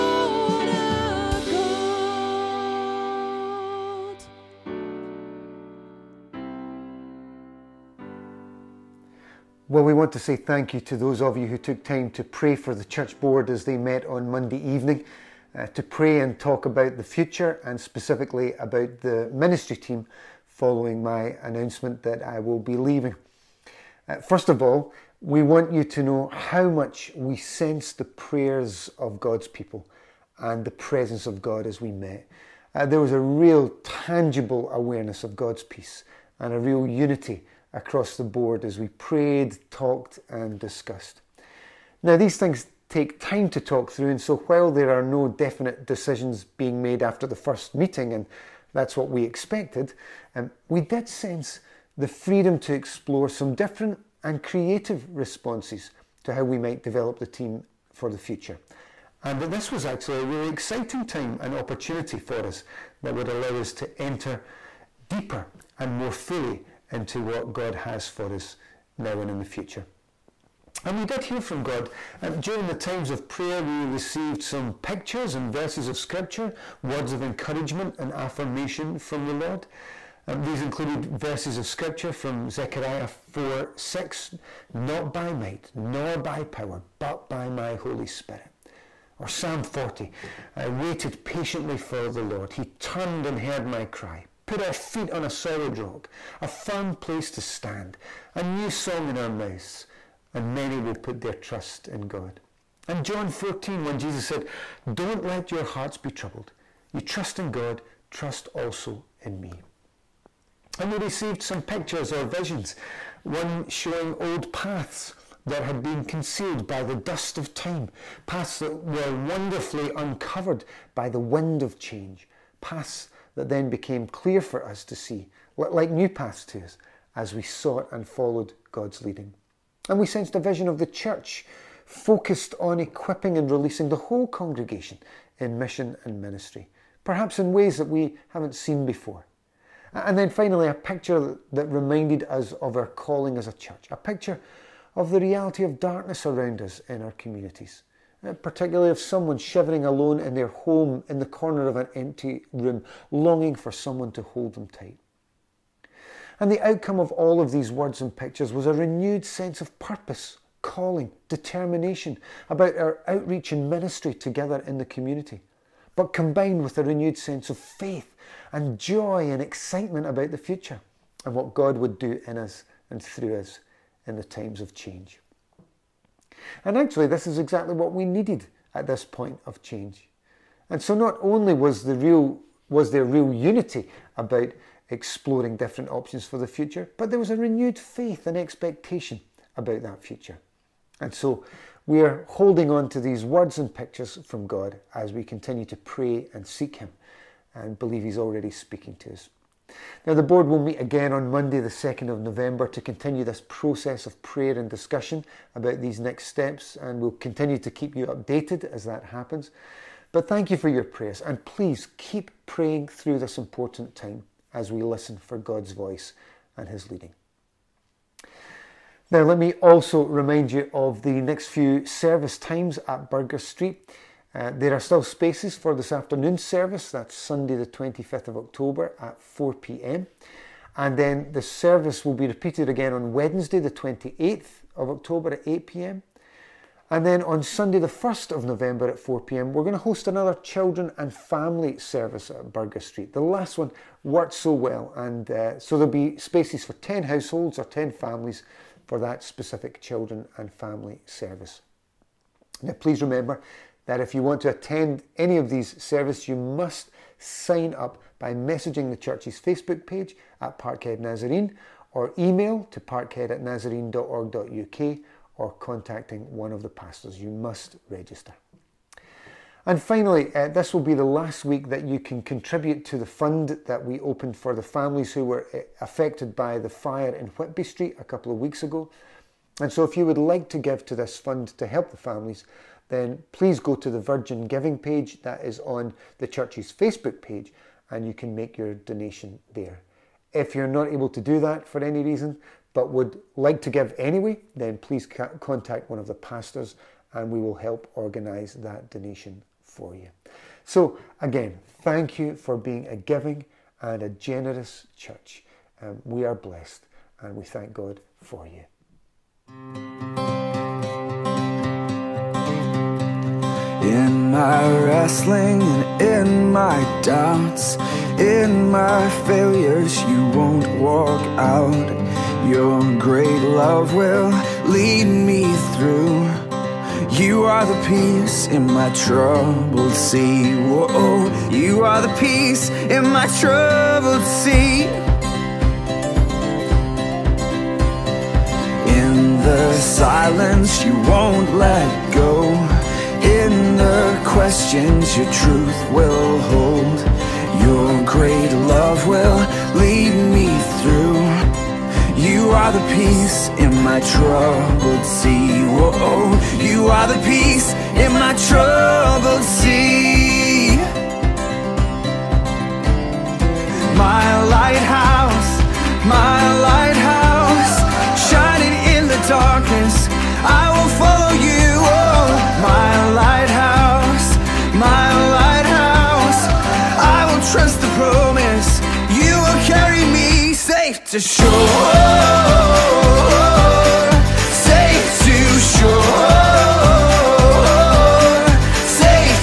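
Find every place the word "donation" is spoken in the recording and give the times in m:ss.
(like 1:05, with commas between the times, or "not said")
4:48, 4:58.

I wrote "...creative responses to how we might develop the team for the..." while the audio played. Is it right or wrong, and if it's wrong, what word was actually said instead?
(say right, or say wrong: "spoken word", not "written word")
right.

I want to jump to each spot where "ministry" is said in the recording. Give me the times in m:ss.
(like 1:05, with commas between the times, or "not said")
0:19, 2:16, 2:43.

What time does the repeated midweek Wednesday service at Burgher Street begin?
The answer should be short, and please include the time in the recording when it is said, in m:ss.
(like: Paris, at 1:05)
8 pm, at 3:55.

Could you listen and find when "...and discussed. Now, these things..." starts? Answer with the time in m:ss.
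0:40.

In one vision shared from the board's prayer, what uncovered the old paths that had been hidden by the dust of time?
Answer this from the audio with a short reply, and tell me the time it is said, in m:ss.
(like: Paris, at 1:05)
The wind of change, at 2:01.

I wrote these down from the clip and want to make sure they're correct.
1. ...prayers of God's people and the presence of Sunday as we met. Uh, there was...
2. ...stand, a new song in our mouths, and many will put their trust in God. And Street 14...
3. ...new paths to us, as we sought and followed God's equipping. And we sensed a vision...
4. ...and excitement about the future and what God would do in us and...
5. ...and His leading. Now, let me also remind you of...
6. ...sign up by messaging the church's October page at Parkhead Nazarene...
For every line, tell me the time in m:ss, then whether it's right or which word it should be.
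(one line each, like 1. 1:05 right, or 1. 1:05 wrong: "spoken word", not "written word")
1. 0:28 wrong: "God", not "Sunday"
2. 1:37 wrong: "John", not "Street"
3. 2:05 wrong: "leading", not "equipping"
4. 2:49 right
5. 3:36 right
6. 4:17 wrong: "Facebook", not "October".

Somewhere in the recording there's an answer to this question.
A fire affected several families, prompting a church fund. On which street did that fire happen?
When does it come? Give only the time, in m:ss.
4:37.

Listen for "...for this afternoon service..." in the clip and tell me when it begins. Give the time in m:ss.
3:45.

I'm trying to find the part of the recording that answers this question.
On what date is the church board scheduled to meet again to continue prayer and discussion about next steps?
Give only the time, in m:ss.
3:21.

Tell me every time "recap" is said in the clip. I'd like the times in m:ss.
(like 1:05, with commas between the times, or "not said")
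not said.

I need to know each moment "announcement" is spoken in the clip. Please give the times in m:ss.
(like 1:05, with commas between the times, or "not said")
0:21.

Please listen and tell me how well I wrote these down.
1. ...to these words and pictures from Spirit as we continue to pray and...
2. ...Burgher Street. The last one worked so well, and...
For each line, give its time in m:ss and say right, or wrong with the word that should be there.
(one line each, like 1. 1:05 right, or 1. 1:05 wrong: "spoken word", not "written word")
1. 3:12 wrong: "God", not "Spirit"
2. 4:02 right.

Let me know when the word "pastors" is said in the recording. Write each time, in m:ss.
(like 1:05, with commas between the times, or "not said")
4:26, 4:56.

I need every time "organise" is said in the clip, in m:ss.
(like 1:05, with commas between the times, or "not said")
4:57.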